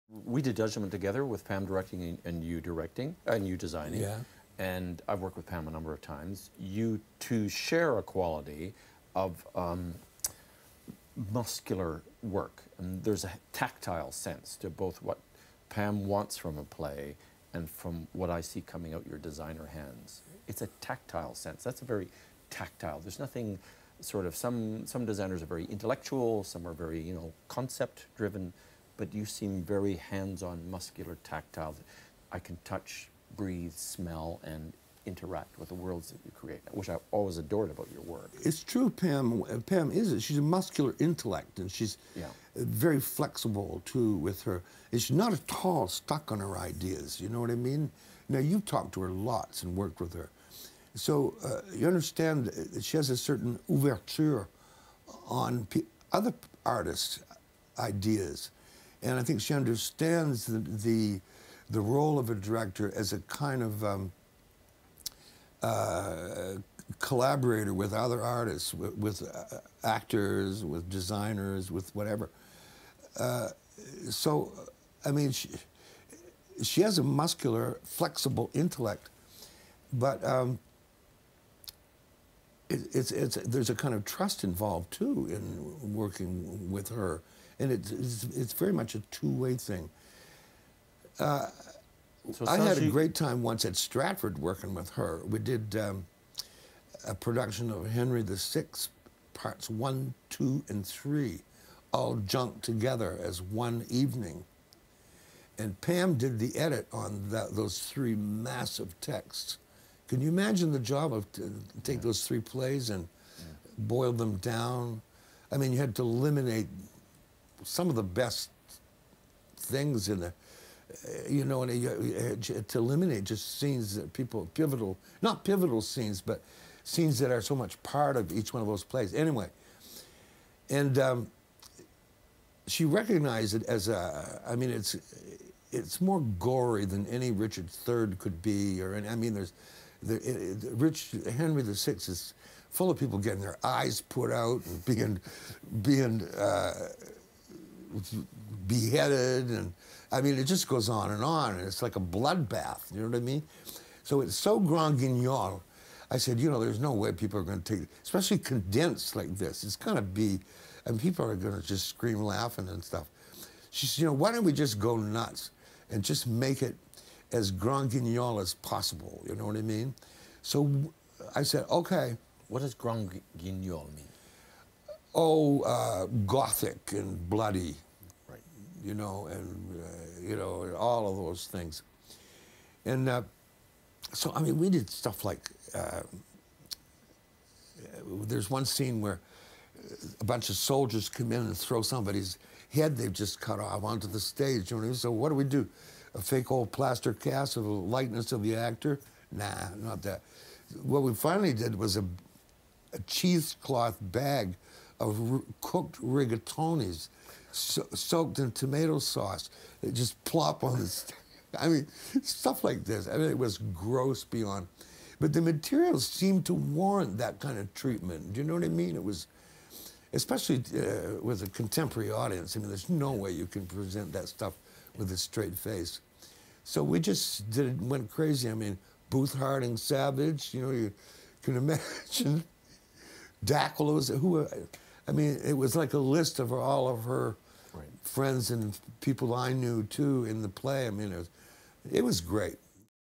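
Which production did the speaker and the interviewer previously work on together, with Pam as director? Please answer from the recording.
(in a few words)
Judgment.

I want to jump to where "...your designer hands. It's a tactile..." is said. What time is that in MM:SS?
00:19.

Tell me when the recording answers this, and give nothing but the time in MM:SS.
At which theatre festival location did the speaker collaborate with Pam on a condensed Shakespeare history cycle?
01:33.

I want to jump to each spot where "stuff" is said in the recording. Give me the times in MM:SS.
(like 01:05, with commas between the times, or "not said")
02:42, 03:04, 03:32, 03:44.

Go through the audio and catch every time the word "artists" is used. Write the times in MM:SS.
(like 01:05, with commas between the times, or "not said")
00:56, 01:08.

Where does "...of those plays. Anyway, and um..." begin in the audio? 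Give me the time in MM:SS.
02:08.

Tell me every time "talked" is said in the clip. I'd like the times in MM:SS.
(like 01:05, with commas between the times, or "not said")
00:48.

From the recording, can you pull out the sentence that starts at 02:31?
And it's like a bloodbath, you know what I mean?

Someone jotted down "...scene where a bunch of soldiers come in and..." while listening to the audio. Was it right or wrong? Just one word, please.
right.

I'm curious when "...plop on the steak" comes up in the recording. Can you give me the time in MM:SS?
03:30.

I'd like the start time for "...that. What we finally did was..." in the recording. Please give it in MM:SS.
03:20.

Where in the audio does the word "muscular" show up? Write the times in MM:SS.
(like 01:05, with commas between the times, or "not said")
00:11, 00:30, 00:40, 01:17.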